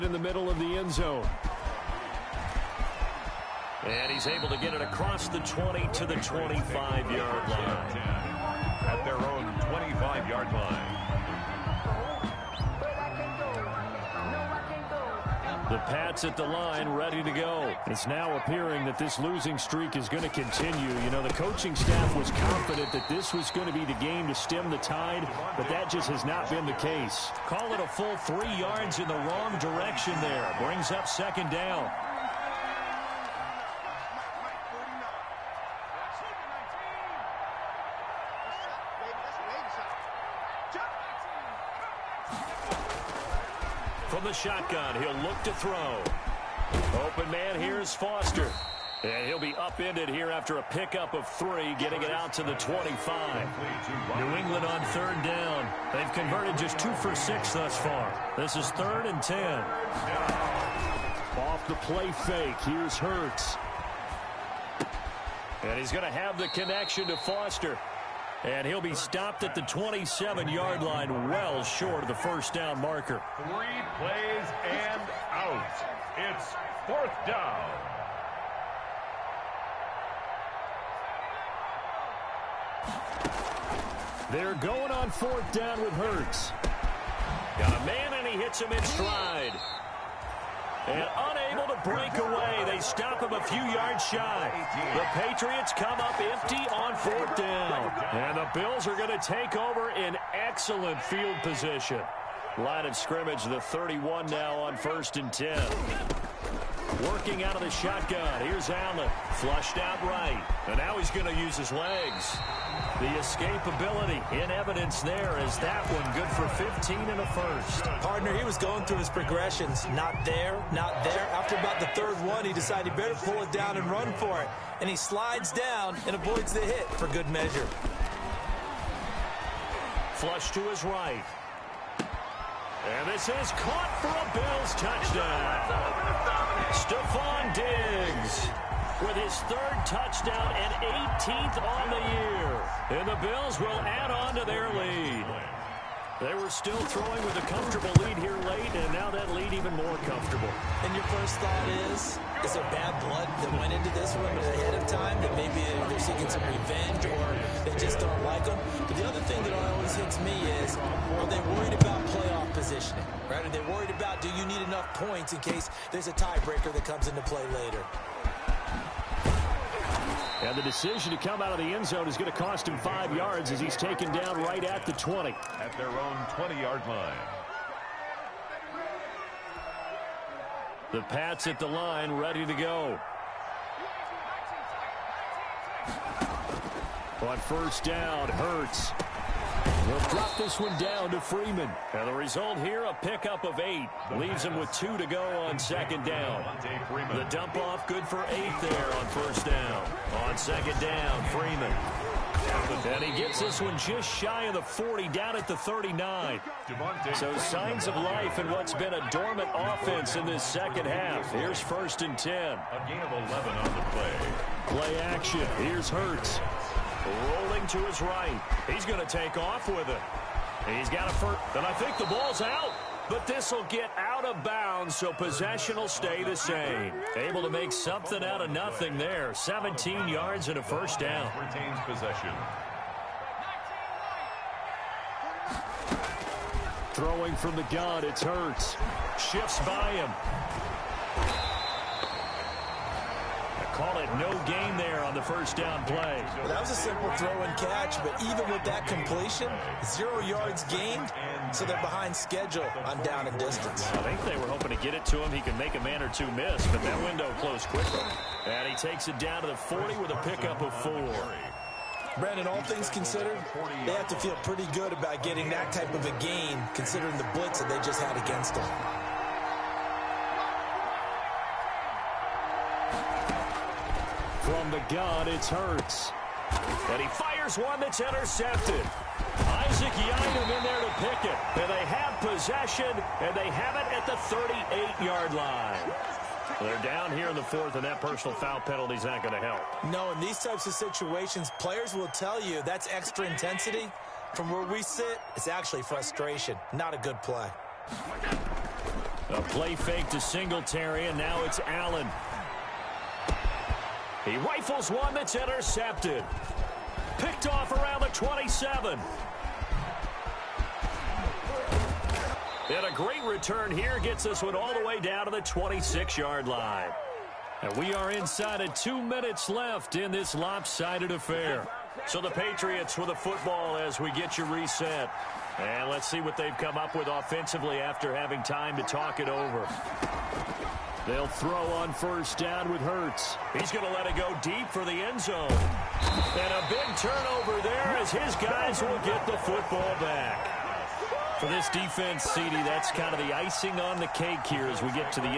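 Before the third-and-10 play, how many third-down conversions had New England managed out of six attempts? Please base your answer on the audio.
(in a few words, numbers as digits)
2.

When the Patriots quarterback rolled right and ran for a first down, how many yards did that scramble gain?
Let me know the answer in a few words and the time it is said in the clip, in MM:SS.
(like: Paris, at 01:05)
17, at 03:49.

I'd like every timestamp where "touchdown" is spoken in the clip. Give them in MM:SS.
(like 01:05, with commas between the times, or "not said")
02:14, 02:19.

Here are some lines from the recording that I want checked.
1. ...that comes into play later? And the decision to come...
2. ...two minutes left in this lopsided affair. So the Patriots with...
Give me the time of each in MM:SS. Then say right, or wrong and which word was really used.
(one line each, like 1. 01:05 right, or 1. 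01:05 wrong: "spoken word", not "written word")
1. 02:46 right
2. 05:18 right.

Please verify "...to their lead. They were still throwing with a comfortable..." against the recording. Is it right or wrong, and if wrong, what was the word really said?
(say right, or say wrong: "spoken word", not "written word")
right.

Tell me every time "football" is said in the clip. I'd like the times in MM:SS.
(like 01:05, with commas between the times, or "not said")
05:23, 05:39.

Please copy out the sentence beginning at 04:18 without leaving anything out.
And he takes it down to the 40 with a pickup of four.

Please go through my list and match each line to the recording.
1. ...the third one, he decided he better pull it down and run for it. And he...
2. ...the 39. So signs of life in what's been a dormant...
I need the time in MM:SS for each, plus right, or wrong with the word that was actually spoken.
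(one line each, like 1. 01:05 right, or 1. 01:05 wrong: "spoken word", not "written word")
1. 02:01 right
2. 03:25 right.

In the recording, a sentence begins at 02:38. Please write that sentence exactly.
But the other thing that always hits me is, are they worried about playoff positioning, right?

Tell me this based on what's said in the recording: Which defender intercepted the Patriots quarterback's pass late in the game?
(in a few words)
Isaac Yiadom.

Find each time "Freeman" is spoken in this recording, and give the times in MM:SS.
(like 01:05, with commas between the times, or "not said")
03:11, 03:21.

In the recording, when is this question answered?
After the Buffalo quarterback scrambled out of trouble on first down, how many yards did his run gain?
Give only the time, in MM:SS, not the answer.
01:56.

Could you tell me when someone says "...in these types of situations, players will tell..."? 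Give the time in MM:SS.
04:50.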